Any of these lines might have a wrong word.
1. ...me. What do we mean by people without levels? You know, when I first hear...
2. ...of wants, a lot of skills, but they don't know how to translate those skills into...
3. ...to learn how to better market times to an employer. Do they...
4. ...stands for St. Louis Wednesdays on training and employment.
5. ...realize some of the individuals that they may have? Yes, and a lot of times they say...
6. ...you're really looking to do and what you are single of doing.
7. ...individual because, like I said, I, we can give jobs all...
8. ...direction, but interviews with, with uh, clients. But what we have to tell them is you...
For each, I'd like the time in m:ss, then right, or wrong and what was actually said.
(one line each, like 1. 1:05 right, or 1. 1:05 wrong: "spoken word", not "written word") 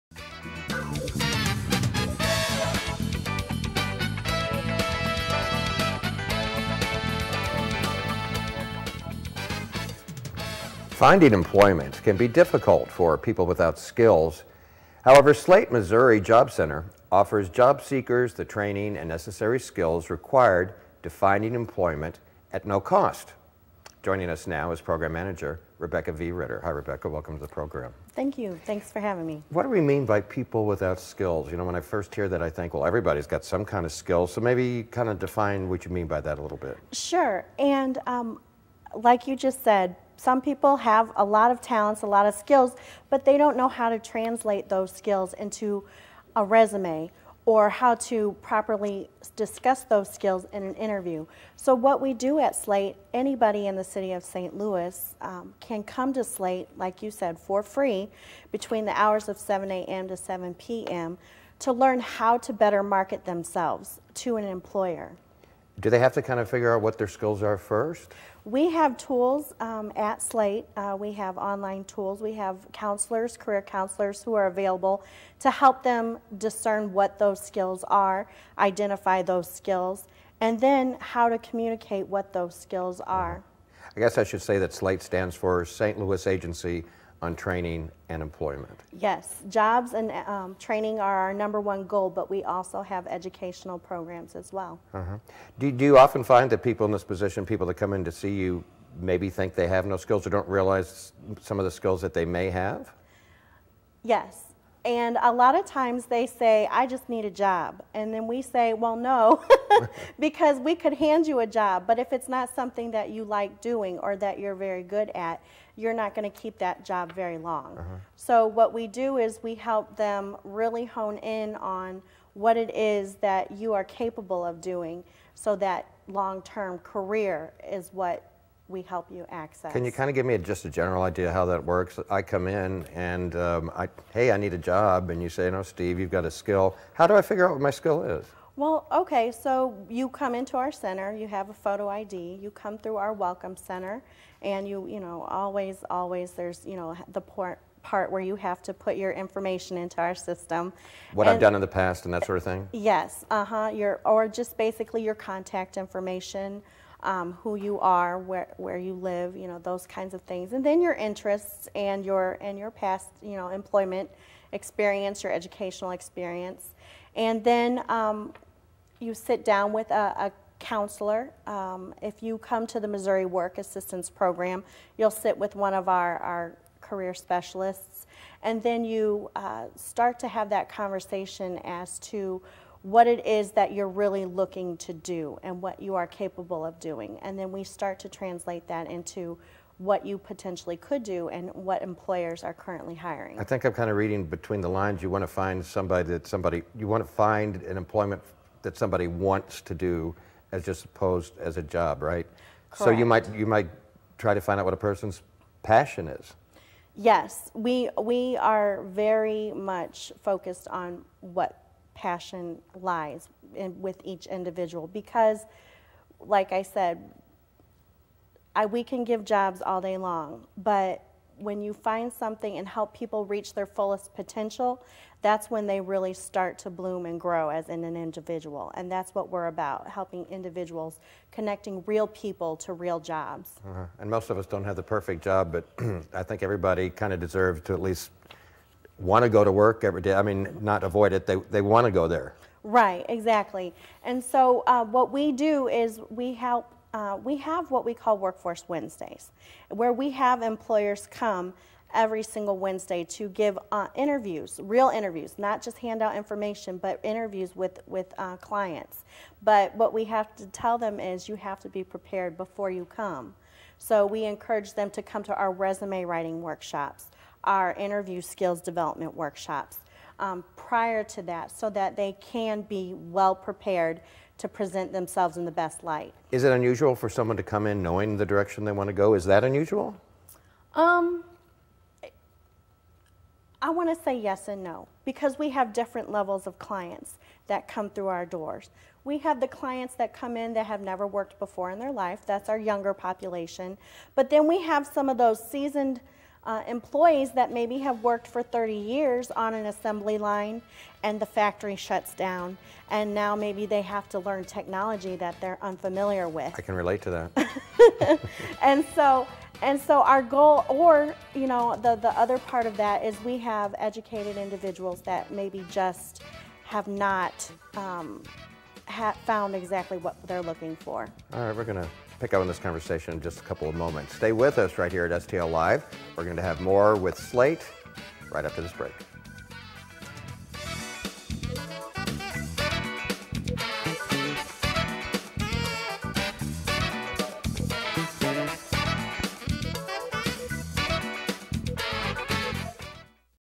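1. 0:29 wrong: "skills", not "levels"
2. 0:41 wrong: "talents", not "wants"
3. 1:01 wrong: "themselves", not "times"
4. 1:25 wrong: "Agency", not "Wednesdays"
5. 1:40 wrong: "skills", not "individuals"
6. 3:03 wrong: "capable", not "single"
7. 3:34 right
8. 4:16 wrong: "information", not "direction".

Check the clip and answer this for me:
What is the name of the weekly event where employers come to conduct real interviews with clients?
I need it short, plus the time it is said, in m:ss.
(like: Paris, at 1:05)
Workforce Wednesdays, at 4:08.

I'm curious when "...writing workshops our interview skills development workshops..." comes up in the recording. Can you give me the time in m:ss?
4:26.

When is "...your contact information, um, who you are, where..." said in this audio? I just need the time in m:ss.
2:35.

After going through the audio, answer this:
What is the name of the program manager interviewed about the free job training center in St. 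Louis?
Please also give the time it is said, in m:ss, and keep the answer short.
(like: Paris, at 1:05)
Rebecca V. Ritter, at 0:25.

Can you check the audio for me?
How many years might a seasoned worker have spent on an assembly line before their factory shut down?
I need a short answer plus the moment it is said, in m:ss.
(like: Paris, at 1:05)
30, at 4:58.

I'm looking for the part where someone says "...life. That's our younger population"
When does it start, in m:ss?
4:51.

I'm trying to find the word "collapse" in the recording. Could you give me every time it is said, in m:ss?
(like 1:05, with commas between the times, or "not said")
not said.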